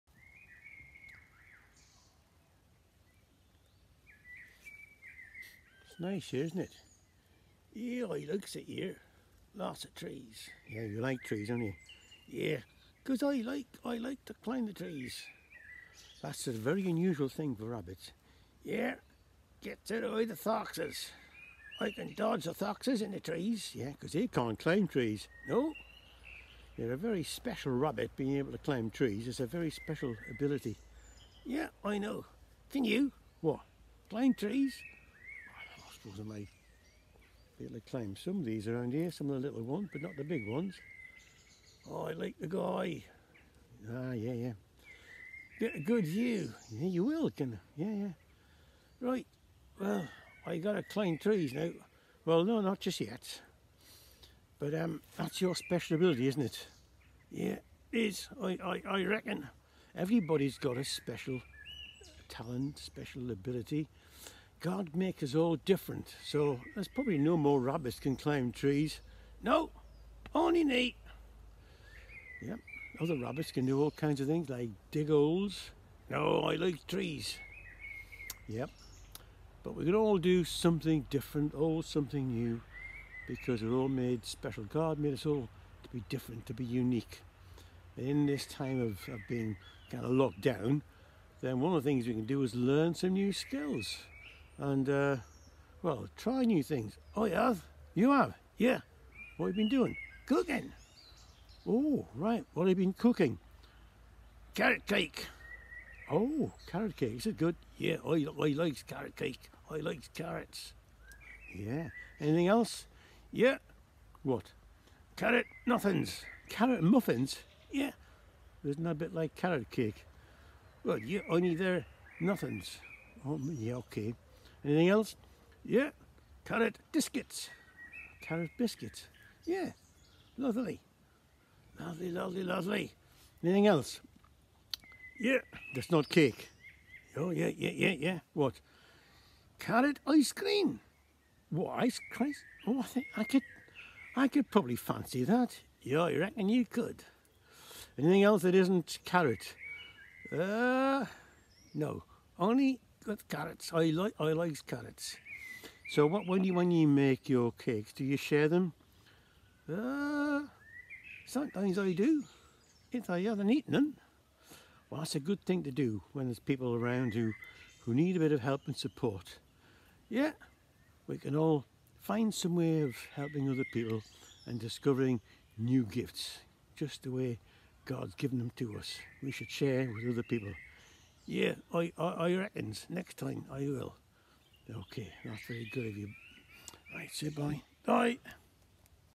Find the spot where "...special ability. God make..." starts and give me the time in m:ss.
1:02.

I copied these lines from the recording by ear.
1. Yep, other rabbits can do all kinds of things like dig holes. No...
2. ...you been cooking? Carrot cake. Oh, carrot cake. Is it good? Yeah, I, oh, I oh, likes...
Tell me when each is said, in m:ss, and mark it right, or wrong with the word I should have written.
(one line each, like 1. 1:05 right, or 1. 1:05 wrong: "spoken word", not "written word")
1. 1:12 right
2. 1:42 right.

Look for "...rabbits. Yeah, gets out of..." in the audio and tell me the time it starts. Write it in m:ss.
0:17.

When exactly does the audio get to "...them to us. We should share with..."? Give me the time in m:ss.
2:58.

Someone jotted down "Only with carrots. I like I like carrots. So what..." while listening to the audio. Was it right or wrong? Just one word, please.
right.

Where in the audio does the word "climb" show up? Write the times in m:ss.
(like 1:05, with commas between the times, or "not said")
0:14, 0:24, 0:28, 0:34, 0:50, 1:08.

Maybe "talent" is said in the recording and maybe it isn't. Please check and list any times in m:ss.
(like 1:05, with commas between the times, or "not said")
1:02.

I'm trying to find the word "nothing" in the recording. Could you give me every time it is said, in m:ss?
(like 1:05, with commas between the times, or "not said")
1:55, 2:02.